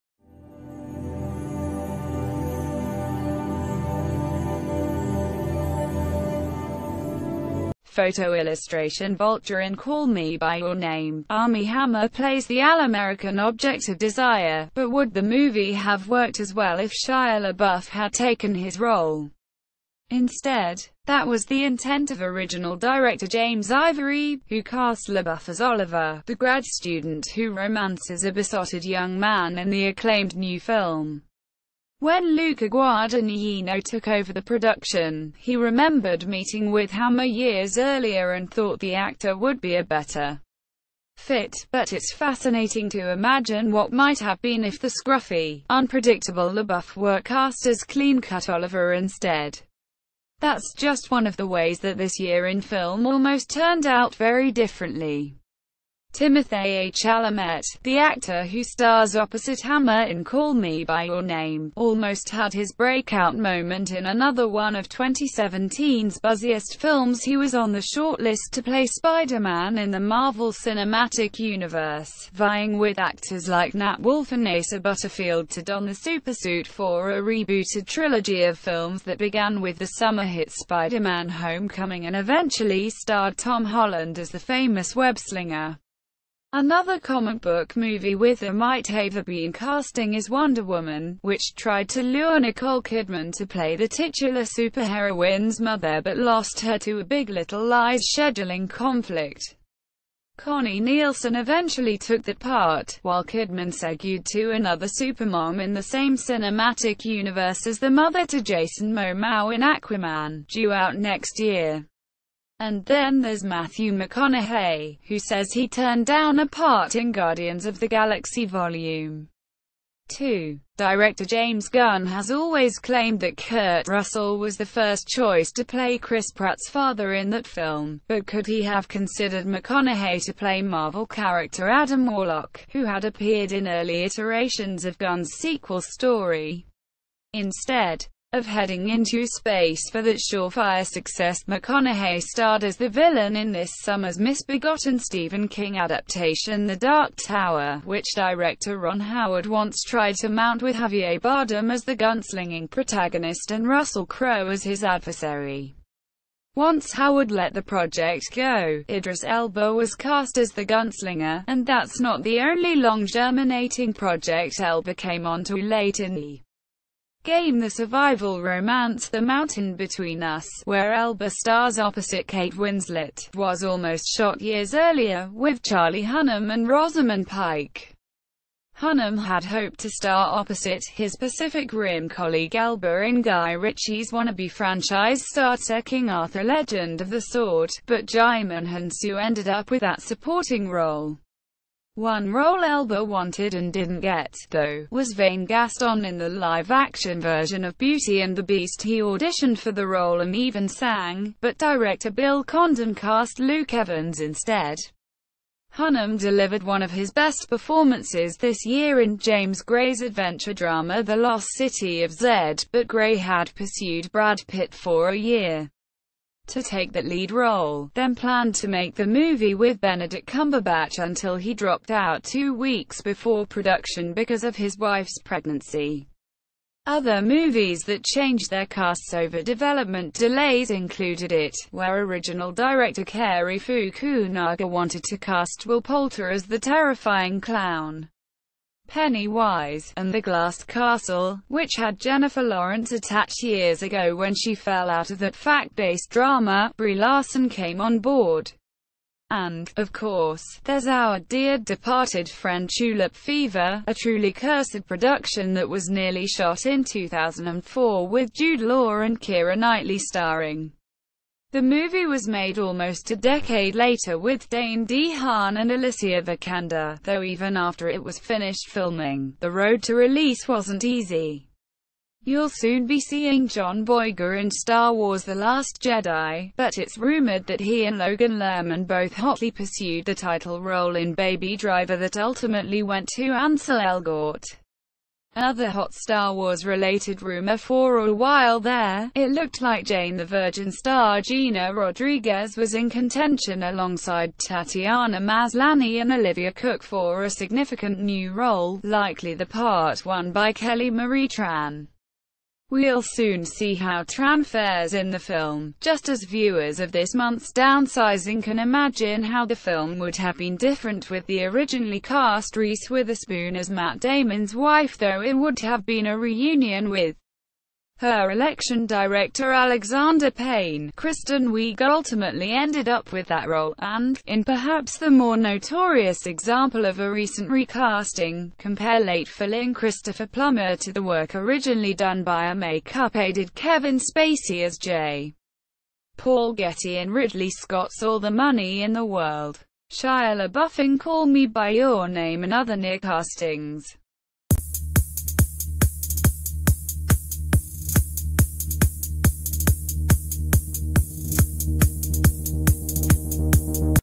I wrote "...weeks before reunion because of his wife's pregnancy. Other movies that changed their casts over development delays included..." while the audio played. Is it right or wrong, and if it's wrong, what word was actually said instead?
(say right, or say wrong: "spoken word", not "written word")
wrong: "production", not "reunion".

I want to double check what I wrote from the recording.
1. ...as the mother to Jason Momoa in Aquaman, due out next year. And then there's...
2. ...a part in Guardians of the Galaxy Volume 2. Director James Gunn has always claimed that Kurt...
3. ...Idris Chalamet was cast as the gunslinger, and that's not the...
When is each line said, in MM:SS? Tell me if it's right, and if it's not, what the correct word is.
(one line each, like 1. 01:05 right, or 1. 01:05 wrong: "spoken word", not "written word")
1. 01:47 right
2. 01:56 right
3. 02:38 wrong: "Elba", not "Chalamet".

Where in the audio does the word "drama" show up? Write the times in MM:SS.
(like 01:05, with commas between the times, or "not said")
03:30, 04:06.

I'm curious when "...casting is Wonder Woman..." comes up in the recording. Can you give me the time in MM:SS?
01:29.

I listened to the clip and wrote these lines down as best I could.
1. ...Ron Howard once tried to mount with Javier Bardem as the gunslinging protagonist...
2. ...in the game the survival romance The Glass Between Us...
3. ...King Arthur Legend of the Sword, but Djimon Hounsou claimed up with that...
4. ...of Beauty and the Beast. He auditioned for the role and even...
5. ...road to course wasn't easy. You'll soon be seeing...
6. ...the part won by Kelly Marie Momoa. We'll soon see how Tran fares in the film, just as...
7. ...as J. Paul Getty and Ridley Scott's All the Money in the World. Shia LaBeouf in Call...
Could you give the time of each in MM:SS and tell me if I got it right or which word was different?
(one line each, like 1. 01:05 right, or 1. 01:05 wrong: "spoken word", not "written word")
1. 02:28 right
2. 02:45 wrong: "Mountain", not "Glass"
3. 03:05 wrong: "ended", not "claimed"
4. 03:17 right
5. 04:29 wrong: "release", not "course"
6. 04:59 wrong: "Tran", not "Momoa"
7. 05:34 right.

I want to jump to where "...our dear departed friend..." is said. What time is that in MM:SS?
04:10.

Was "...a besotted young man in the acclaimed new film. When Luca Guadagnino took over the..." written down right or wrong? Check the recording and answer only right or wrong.
right.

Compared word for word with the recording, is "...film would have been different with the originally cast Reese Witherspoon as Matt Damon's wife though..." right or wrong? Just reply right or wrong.
right.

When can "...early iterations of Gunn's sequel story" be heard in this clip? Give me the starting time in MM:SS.
02:13.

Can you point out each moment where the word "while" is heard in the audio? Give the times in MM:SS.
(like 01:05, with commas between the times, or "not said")
01:43, 04:48.